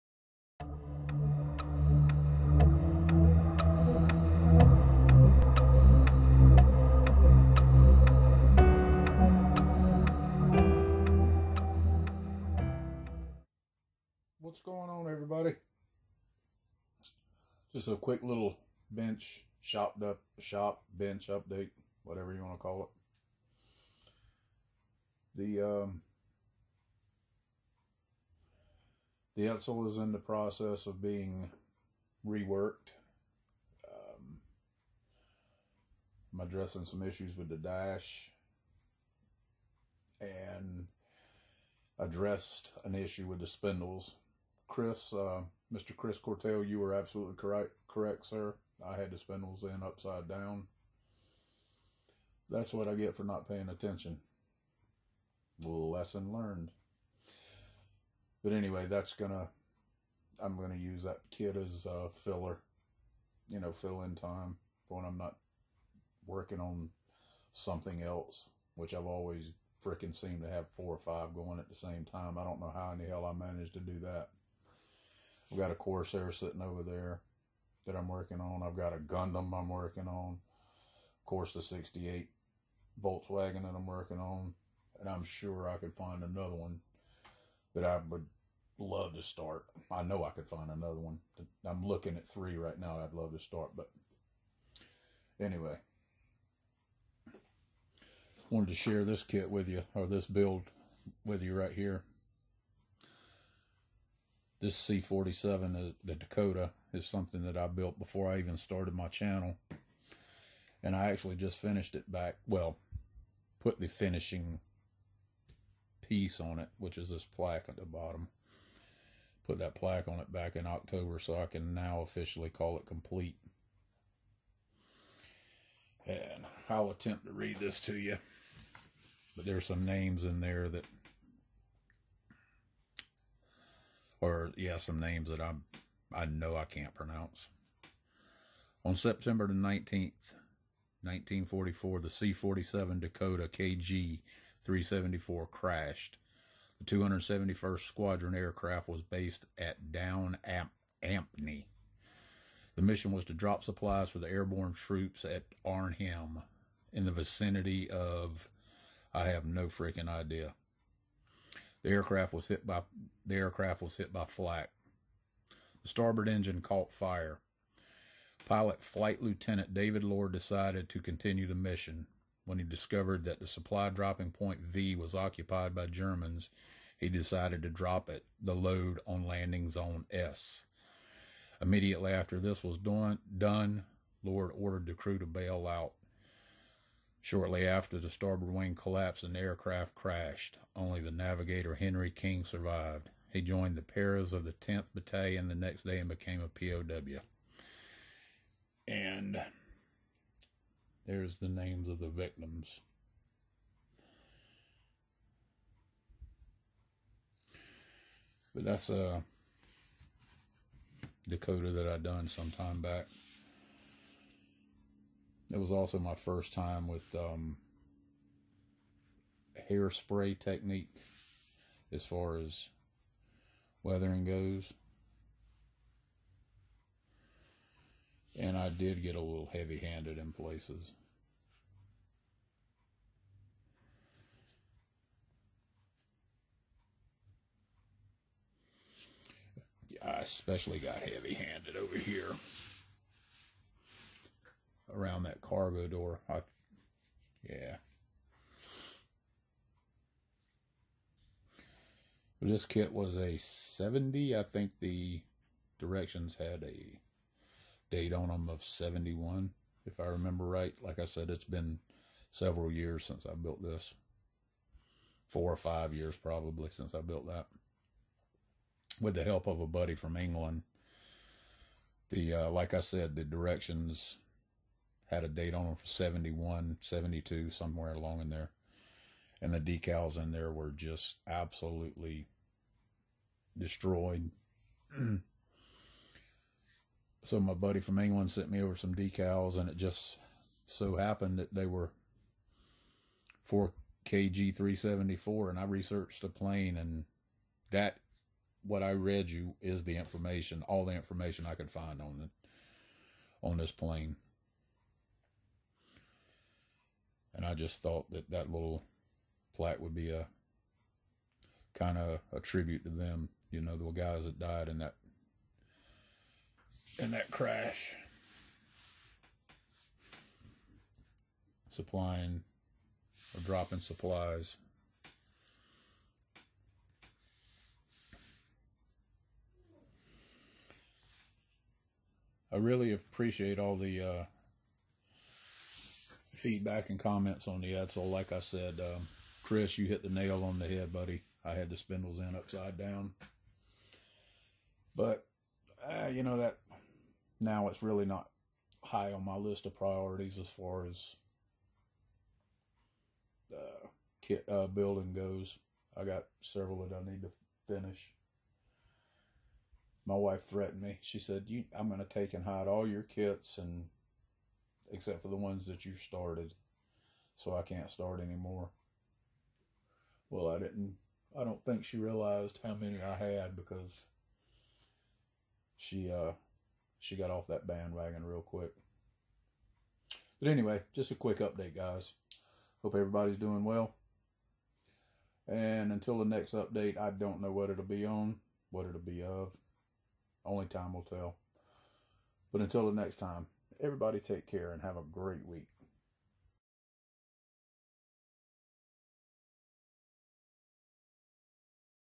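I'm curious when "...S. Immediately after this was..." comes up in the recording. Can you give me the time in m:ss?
3:00.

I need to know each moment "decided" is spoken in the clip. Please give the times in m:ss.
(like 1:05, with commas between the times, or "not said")
2:50, 2:57.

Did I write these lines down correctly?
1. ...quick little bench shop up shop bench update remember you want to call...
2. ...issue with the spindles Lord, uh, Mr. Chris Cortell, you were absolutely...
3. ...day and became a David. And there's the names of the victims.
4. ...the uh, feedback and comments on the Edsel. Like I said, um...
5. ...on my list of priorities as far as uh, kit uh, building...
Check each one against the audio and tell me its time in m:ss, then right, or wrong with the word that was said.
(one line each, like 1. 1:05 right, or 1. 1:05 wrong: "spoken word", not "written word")
1. 0:17 wrong: "whatever", not "remember"
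2. 0:42 wrong: "Chris", not "Lord"
3. 3:15 wrong: "POW", not "David"
4. 5:33 right
5. 5:49 right.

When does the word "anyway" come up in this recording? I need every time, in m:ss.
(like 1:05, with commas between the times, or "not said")
0:58, 1:35, 6:20.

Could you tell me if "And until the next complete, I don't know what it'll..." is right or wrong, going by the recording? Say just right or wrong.
wrong.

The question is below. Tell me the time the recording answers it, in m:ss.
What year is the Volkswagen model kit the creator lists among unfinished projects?
1:21.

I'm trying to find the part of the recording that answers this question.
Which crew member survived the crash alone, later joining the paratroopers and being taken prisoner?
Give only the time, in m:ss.
3:11.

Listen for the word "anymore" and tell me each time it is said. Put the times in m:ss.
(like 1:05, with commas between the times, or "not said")
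6:08.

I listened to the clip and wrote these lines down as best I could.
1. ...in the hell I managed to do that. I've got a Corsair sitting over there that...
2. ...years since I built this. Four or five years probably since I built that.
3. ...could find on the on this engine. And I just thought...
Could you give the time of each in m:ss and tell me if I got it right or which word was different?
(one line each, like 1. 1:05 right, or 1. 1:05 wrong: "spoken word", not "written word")
1. 1:12 right
2. 4:22 right
3. 5:01 wrong: "plane", not "engine".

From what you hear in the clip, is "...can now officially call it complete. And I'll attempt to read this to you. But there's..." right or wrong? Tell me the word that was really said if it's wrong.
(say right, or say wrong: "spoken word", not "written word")
right.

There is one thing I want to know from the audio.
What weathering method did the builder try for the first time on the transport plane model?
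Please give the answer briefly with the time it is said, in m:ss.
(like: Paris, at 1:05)
Hairspray technique, at 3:39.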